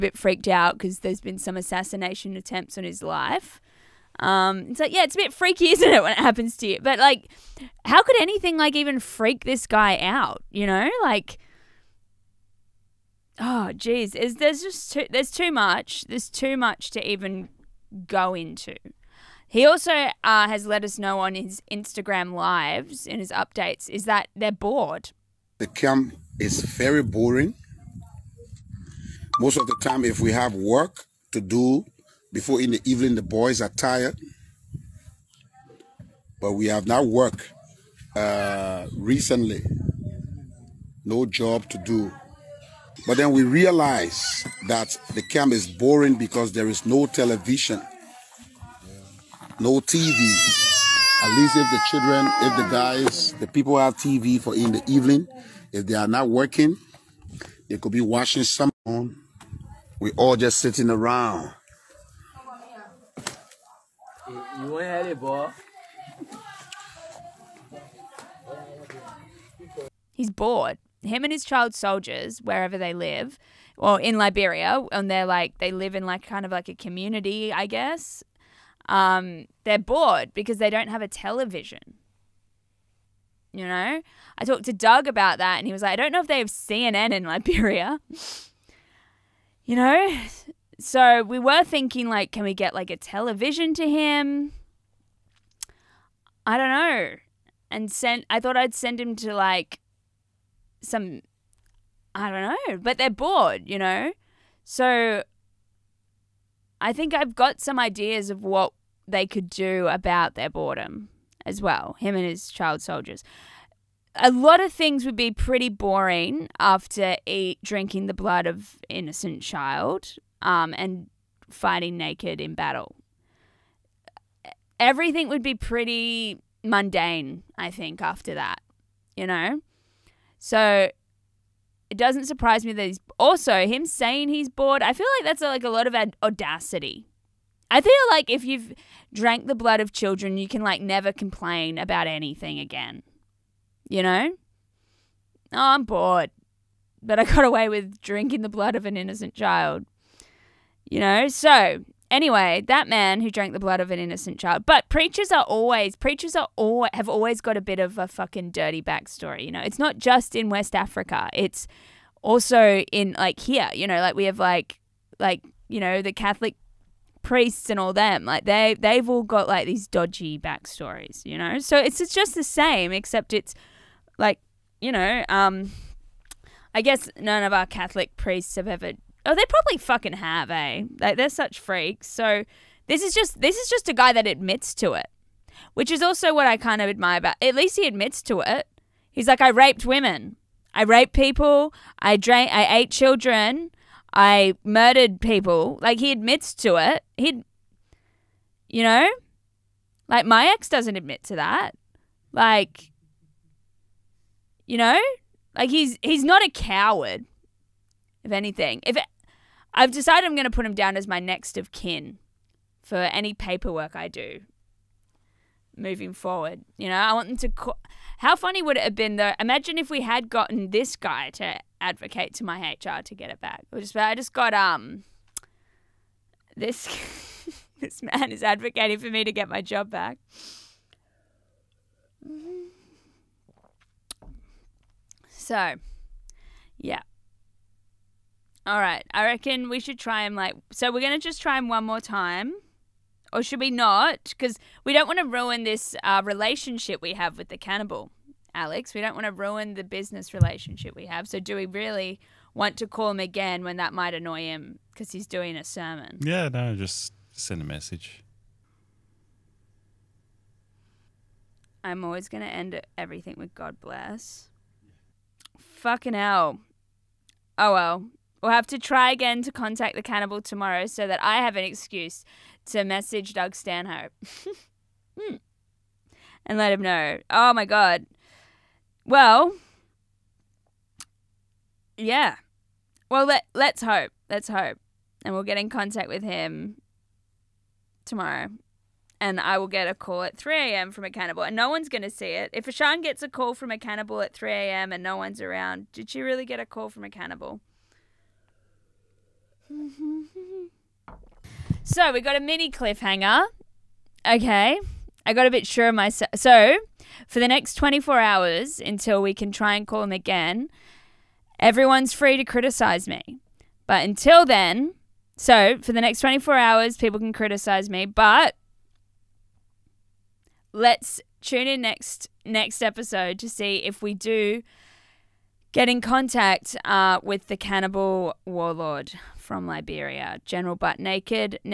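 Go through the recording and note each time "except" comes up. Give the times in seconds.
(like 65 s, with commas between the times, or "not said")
172 s.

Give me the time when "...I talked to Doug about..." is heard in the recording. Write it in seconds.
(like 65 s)
84 s.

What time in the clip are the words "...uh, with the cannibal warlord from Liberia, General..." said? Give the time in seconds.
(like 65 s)
326 s.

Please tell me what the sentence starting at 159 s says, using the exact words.
You know, it's not just in West Africa.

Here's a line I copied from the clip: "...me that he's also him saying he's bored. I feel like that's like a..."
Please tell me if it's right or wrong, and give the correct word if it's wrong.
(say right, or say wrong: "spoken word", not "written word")
right.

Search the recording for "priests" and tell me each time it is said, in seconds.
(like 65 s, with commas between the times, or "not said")
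167 s, 178 s.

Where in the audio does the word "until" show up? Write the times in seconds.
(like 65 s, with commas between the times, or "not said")
308 s, 314 s.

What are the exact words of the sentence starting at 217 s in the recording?
Co- How funny would it have been though?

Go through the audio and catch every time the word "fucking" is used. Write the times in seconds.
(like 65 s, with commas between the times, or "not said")
158 s, 179 s, 265 s.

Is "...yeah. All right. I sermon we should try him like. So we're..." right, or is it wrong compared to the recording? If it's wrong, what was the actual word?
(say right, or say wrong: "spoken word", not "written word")
wrong: "reckon", not "sermon".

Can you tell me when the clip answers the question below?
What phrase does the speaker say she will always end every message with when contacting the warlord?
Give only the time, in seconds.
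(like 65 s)
263 s.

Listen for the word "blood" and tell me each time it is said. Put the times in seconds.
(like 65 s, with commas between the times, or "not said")
118 s, 139 s, 148 s, 153 s.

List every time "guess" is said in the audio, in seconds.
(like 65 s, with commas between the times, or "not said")
77 s, 176 s.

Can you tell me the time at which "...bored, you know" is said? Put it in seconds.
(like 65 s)
103 s.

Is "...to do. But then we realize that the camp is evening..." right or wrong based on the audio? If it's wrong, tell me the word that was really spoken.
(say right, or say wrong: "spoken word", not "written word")
wrong: "boring", not "evening".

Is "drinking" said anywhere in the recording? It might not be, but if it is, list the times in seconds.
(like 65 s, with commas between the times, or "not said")
117 s, 147 s.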